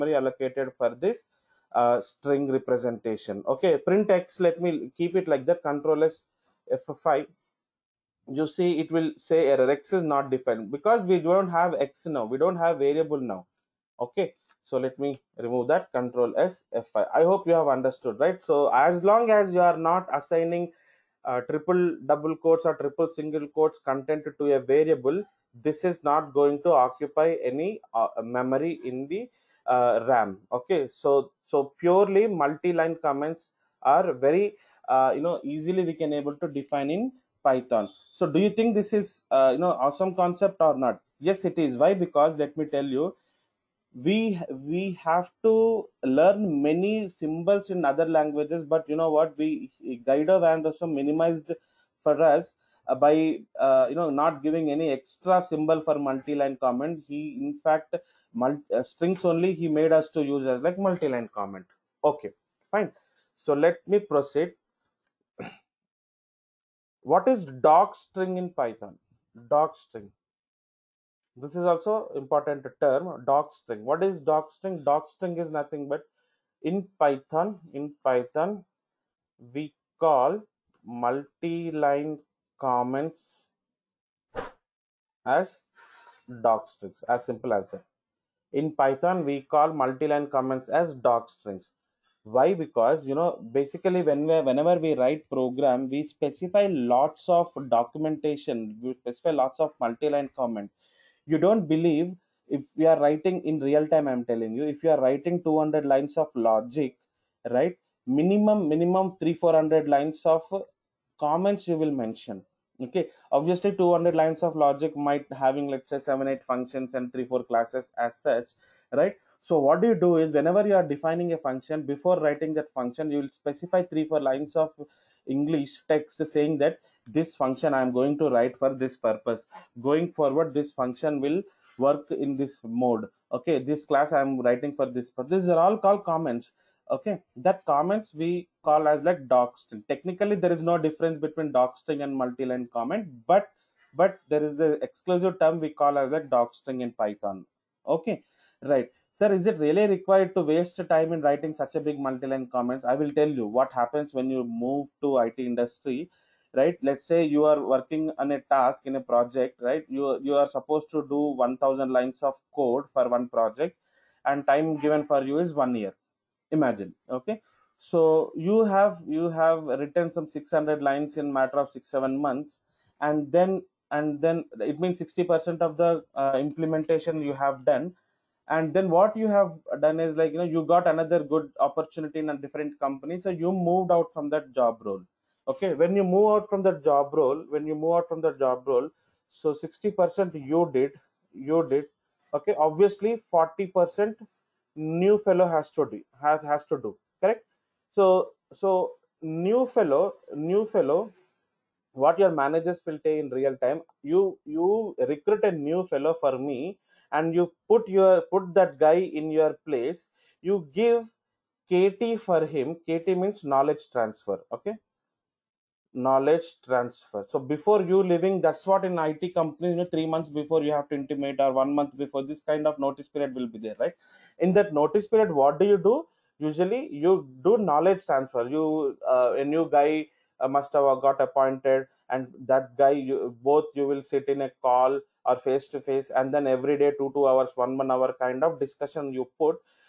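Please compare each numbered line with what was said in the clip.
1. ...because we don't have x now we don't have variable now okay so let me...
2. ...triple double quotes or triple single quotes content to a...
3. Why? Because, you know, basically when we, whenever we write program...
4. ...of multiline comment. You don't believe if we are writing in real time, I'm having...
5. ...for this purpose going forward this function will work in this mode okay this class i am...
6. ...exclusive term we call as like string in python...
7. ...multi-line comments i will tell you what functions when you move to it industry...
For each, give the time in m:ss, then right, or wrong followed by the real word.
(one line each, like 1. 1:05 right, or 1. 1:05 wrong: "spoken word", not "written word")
1. 0:10 right
2. 0:21 right
3. 1:32 right
4. 1:39 wrong: "telling", not "having"
5. 2:08 right
6. 2:24 right
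7. 2:32 wrong: "happens", not "functions".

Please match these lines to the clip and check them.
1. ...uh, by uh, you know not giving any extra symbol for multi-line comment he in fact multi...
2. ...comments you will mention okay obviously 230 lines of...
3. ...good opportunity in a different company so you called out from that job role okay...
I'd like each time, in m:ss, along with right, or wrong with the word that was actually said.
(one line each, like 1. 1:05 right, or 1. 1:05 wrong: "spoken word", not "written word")
1. 0:52 right
2. 1:51 wrong: "200", not "230"
3. 3:01 wrong: "moved", not "called".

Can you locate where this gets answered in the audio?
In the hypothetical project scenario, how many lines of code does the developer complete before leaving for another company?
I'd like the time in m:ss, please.
2:50.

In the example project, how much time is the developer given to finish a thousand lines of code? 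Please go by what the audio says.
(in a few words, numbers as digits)
one year.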